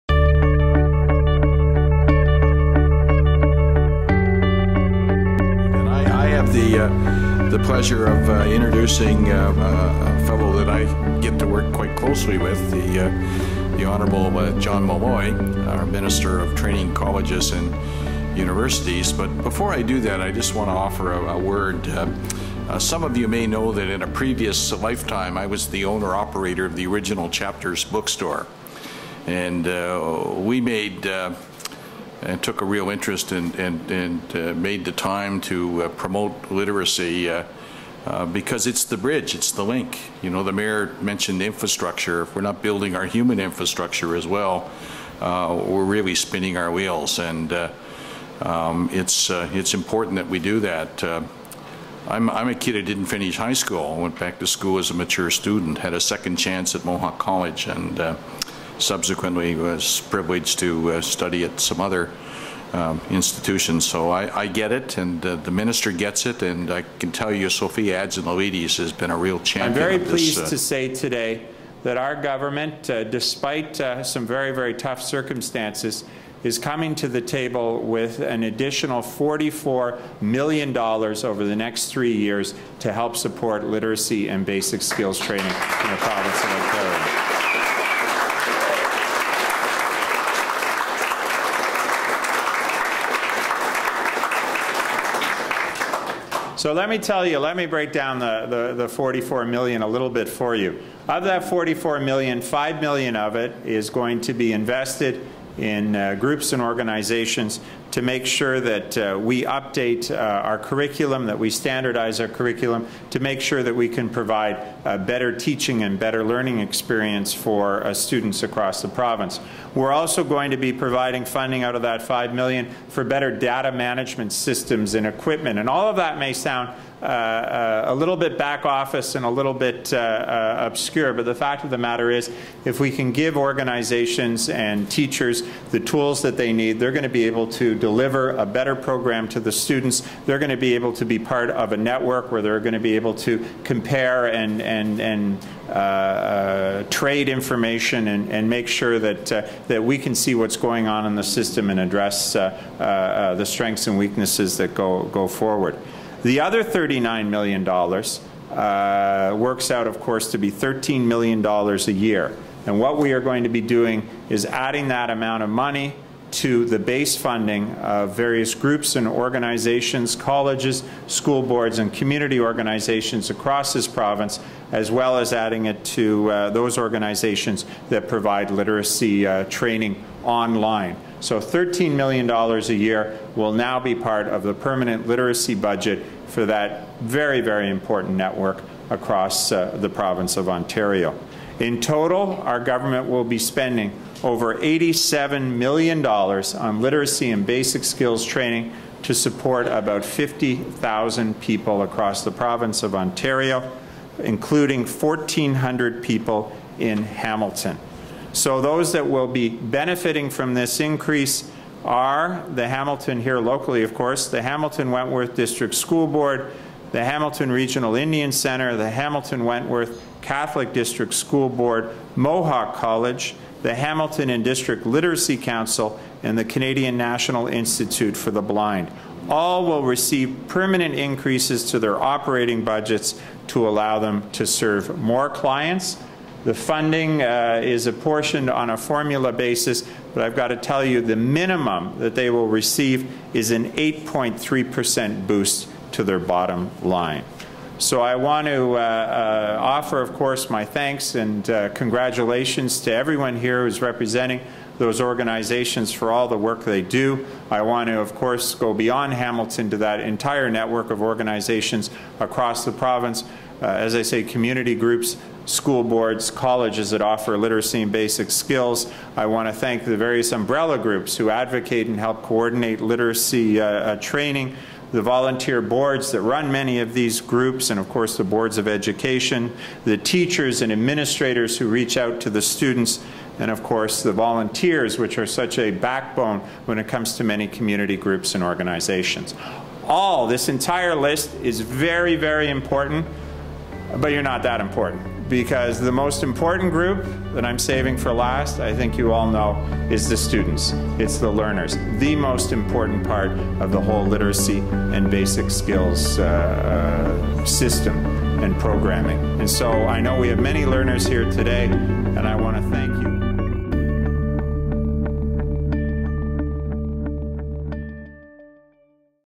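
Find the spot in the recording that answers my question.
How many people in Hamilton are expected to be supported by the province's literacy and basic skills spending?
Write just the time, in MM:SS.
03:24.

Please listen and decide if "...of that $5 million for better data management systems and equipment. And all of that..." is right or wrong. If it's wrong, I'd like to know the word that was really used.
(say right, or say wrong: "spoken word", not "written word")
right.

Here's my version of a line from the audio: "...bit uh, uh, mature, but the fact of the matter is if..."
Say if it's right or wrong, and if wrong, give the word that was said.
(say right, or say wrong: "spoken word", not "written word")
wrong: "obscure", not "mature".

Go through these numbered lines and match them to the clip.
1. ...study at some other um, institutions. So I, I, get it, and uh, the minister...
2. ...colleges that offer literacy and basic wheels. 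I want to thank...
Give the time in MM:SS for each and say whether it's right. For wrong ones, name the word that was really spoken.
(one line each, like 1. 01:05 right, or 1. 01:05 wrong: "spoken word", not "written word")
1. 01:01 right
2. 04:26 wrong: "skills", not "wheels".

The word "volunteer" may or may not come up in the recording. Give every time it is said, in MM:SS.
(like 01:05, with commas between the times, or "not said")
04:35, 04:44.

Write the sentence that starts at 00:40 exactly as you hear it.
You know, the mayor mentioned infrastructure.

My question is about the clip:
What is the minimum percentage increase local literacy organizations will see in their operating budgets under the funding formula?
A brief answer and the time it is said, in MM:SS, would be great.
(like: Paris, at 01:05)
8.3%, at 04:03.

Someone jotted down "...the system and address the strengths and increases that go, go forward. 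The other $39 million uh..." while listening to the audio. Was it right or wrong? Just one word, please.
wrong.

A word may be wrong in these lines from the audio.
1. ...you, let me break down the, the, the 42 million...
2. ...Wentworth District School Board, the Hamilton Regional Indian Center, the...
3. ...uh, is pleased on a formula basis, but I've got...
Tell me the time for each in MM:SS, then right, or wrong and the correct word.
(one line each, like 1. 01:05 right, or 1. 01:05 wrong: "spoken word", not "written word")
1. 01:37 wrong: "44", not "42"
2. 03:34 right
3. 03:57 wrong: "apportioned", not "pleased".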